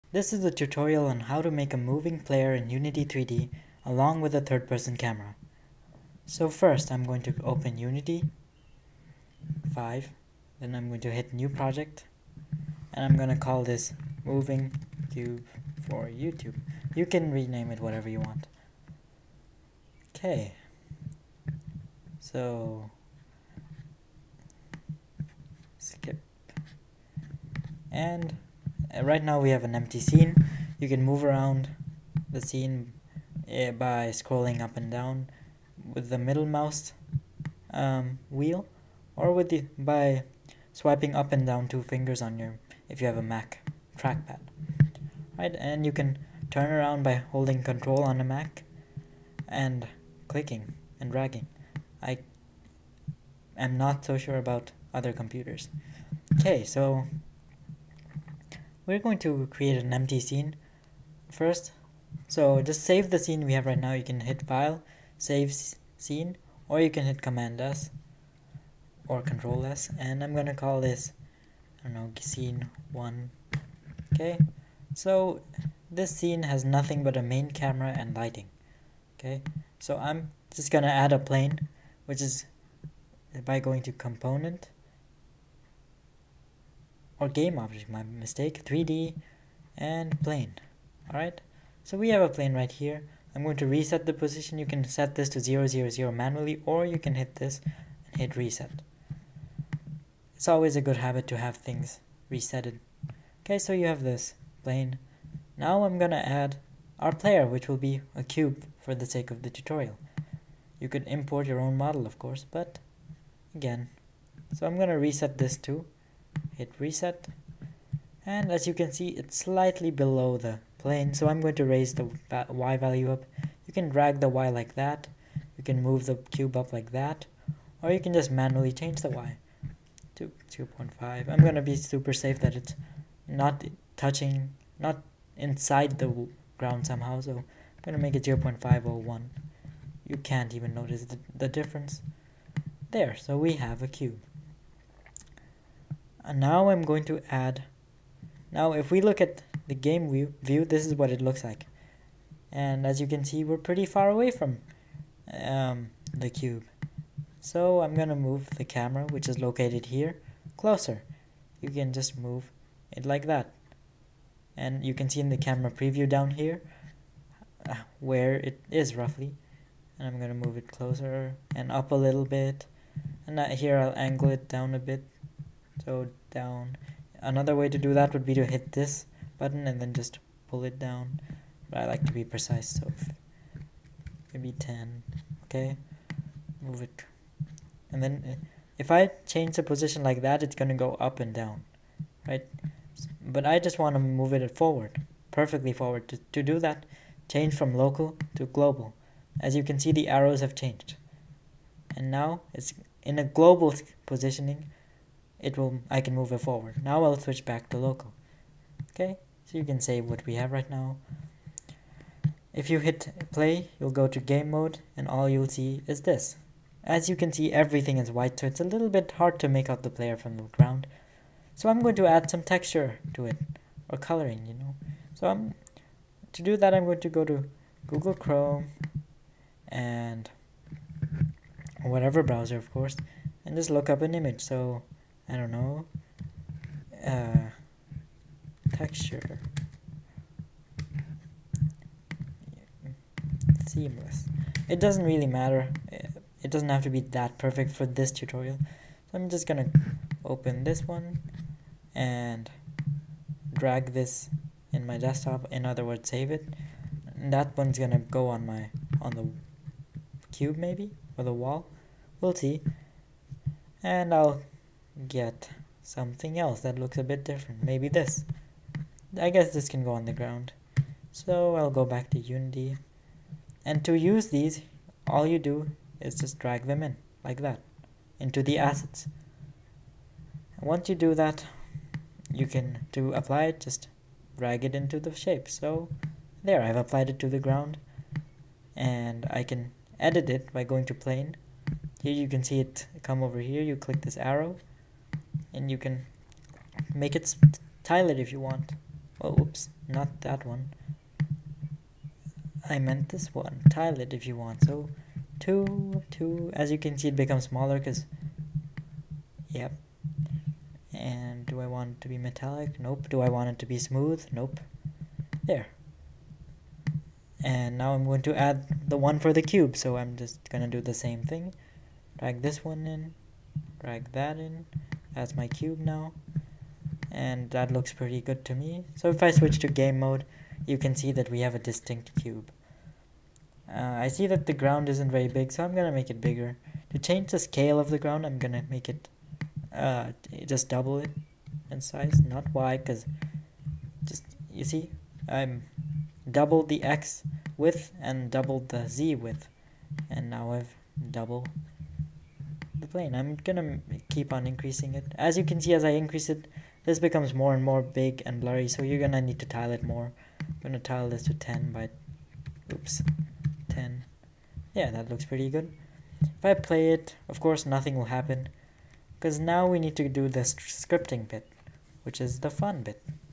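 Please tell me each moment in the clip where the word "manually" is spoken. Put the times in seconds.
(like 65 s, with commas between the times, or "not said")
96 s, 128 s.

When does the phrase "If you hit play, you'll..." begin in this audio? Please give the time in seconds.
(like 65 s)
212 s.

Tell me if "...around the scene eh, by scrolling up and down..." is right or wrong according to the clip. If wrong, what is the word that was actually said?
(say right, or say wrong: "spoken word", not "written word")
right.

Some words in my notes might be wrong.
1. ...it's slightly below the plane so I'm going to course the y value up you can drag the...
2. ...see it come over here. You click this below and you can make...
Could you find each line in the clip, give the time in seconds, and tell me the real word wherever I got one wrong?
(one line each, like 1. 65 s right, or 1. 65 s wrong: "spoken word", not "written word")
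1. 119 s wrong: "raise", not "course"
2. 292 s wrong: "arrow", not "below".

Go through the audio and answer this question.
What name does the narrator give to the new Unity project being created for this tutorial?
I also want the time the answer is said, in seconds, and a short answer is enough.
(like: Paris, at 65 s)
moving cube for YouTube, at 14 s.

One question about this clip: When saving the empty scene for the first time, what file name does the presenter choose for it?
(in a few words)
scene one.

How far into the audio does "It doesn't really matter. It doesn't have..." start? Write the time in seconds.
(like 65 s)
244 s.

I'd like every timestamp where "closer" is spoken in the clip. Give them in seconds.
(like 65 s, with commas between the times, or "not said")
160 s, 170 s.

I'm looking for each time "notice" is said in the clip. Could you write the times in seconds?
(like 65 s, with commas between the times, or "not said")
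140 s.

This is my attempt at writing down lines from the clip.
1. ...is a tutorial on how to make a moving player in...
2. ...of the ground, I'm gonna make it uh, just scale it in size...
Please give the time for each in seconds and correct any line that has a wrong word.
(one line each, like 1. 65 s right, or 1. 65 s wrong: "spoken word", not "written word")
1. 0 s right
2. 337 s wrong: "double", not "scale".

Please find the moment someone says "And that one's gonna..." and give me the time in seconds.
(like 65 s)
257 s.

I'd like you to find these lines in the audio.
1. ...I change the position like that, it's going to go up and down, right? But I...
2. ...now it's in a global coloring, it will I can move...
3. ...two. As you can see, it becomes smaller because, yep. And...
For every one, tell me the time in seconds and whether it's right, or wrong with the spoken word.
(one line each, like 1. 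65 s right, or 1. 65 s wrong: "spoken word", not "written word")
1. 188 s right
2. 202 s wrong: "positioning", not "coloring"
3. 306 s right.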